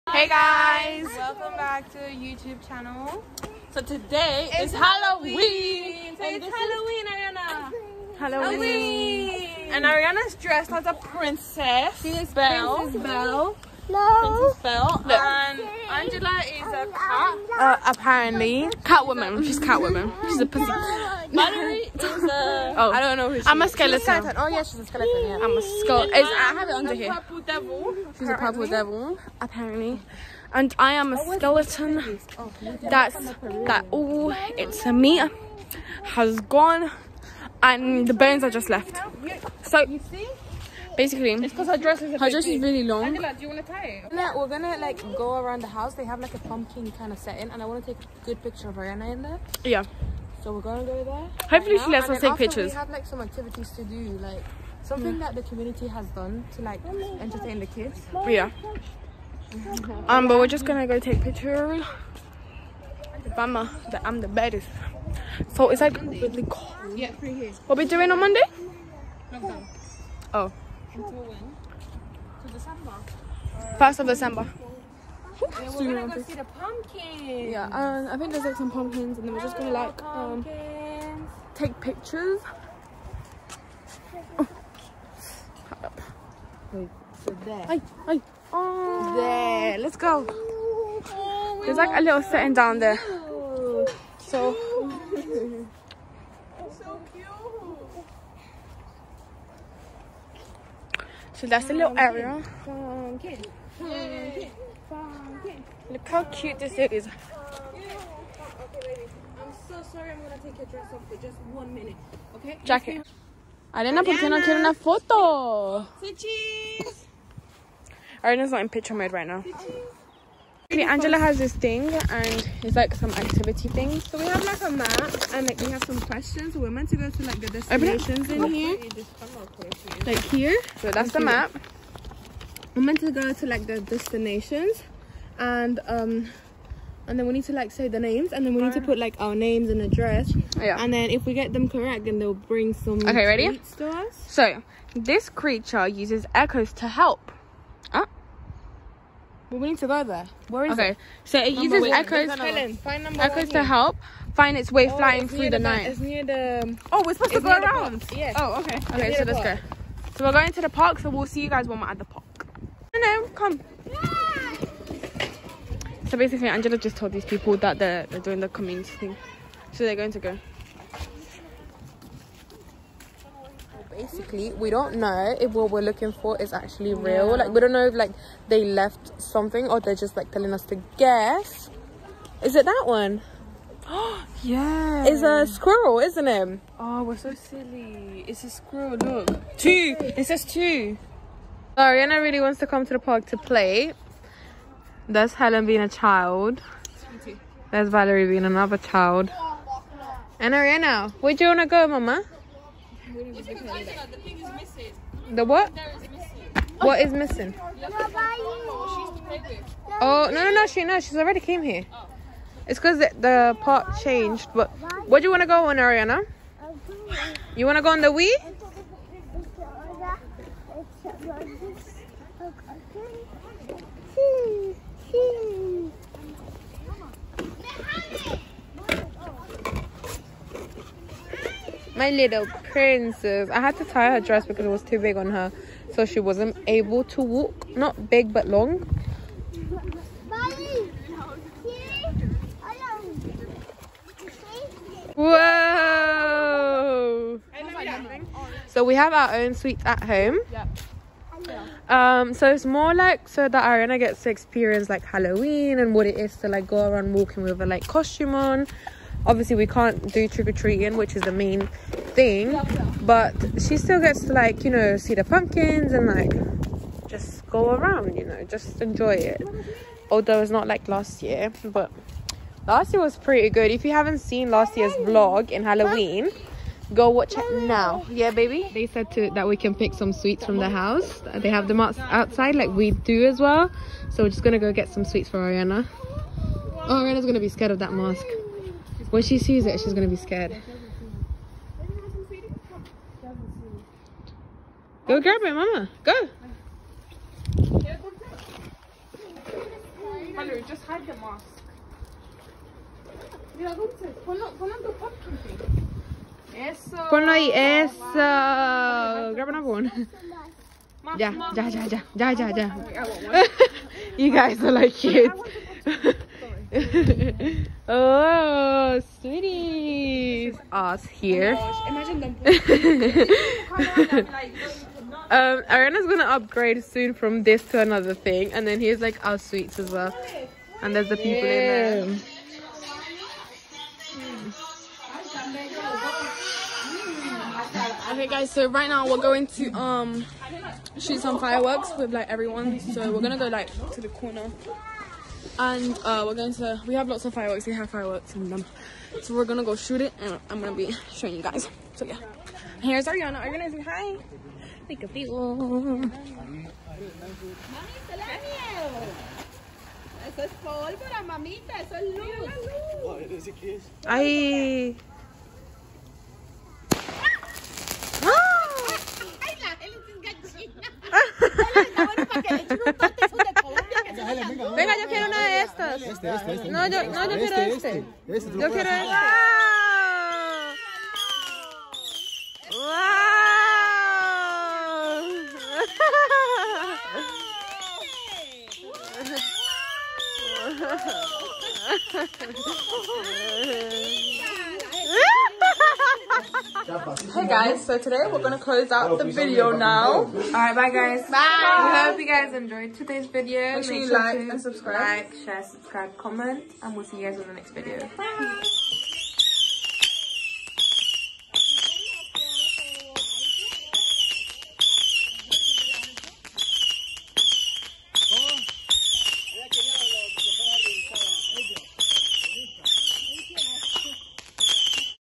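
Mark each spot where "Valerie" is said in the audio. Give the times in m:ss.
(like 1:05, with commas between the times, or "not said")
0:20, 3:17.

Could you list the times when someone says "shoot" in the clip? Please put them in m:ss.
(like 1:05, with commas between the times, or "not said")
5:40, 5:49.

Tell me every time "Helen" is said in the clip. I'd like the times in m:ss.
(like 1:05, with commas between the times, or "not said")
2:32, 3:15.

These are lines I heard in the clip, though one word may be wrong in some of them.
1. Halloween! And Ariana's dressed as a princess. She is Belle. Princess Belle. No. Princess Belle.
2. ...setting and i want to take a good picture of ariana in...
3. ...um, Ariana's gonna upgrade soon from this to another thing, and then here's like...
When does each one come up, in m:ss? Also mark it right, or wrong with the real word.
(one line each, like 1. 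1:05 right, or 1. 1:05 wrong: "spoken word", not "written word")
1. 0:09 right
2. 0:47 right
3. 5:25 right.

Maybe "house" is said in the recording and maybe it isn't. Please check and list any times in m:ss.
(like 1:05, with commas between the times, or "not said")
0:45, 4:40.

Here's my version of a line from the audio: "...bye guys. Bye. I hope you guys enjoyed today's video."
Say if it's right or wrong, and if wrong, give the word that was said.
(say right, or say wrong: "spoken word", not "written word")
right.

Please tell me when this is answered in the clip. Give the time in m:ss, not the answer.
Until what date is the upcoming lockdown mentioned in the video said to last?
1:13.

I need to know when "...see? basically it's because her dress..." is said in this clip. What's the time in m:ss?
0:40.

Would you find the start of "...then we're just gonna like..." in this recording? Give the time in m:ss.
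1:19.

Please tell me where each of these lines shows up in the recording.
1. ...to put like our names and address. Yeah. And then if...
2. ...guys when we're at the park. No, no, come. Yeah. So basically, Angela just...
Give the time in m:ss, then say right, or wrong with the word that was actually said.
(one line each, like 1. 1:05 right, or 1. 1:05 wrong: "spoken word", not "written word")
1. 2:18 right
2. 2:41 right.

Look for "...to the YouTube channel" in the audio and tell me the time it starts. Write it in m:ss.
0:01.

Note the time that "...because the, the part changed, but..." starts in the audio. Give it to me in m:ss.
3:32.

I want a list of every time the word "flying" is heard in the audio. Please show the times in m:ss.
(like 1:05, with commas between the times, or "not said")
2:34.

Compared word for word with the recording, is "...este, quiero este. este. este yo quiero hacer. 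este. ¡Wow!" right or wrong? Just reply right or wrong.
right.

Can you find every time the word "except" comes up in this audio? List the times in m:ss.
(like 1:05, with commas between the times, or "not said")
not said.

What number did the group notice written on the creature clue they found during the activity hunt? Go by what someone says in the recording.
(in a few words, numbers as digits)
2.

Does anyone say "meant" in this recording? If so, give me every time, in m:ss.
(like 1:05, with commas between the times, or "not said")
2:06, 2:12.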